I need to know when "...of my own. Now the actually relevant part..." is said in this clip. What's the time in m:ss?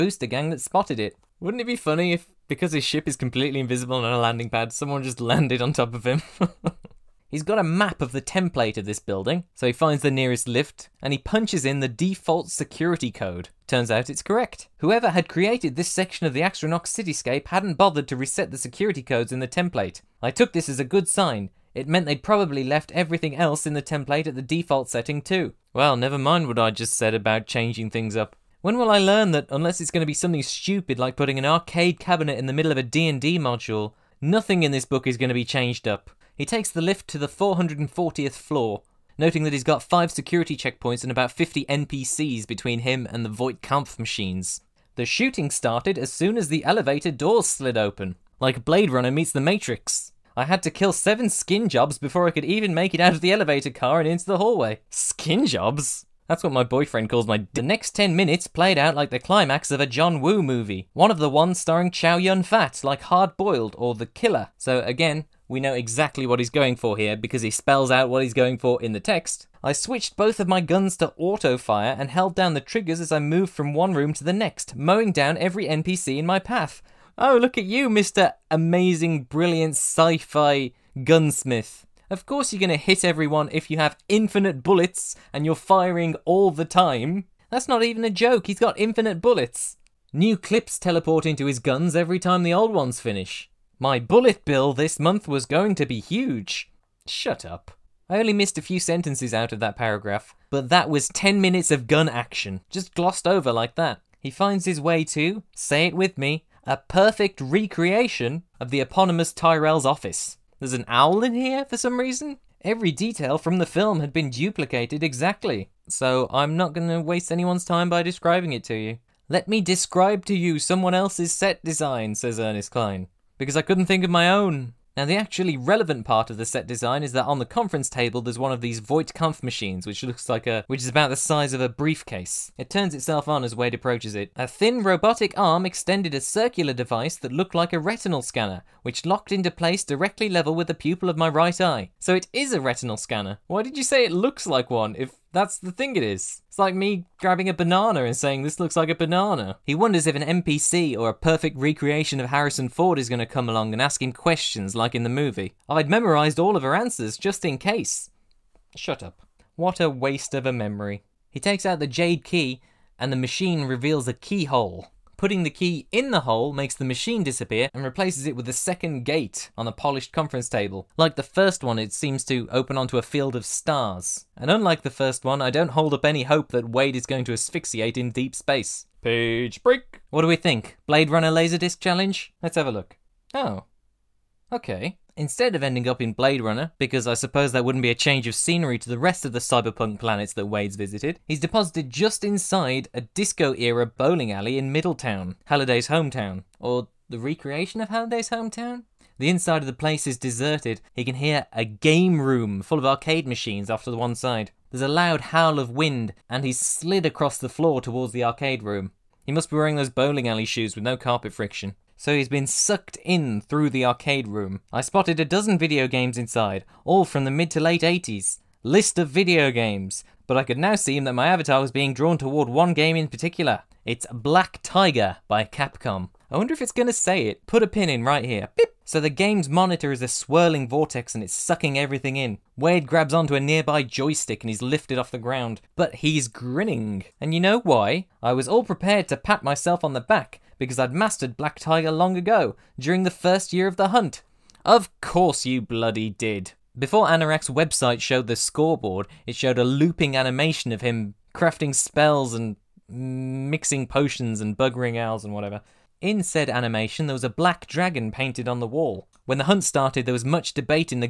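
2:04.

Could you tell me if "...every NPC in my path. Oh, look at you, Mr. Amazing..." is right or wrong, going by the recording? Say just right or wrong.
right.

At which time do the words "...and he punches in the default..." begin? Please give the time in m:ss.
0:11.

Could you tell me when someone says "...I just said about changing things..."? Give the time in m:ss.
0:26.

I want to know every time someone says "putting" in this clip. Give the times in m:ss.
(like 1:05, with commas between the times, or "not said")
0:31, 2:45.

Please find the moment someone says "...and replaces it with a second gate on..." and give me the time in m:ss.
2:47.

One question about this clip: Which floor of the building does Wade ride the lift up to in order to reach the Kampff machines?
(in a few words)
440th.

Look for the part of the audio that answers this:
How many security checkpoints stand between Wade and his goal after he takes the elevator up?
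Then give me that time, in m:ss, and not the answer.
0:39.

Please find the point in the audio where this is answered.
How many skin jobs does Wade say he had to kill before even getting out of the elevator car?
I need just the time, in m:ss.
0:50.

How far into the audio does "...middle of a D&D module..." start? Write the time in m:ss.
0:32.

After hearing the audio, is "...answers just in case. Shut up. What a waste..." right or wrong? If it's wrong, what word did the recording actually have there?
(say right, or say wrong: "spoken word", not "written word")
right.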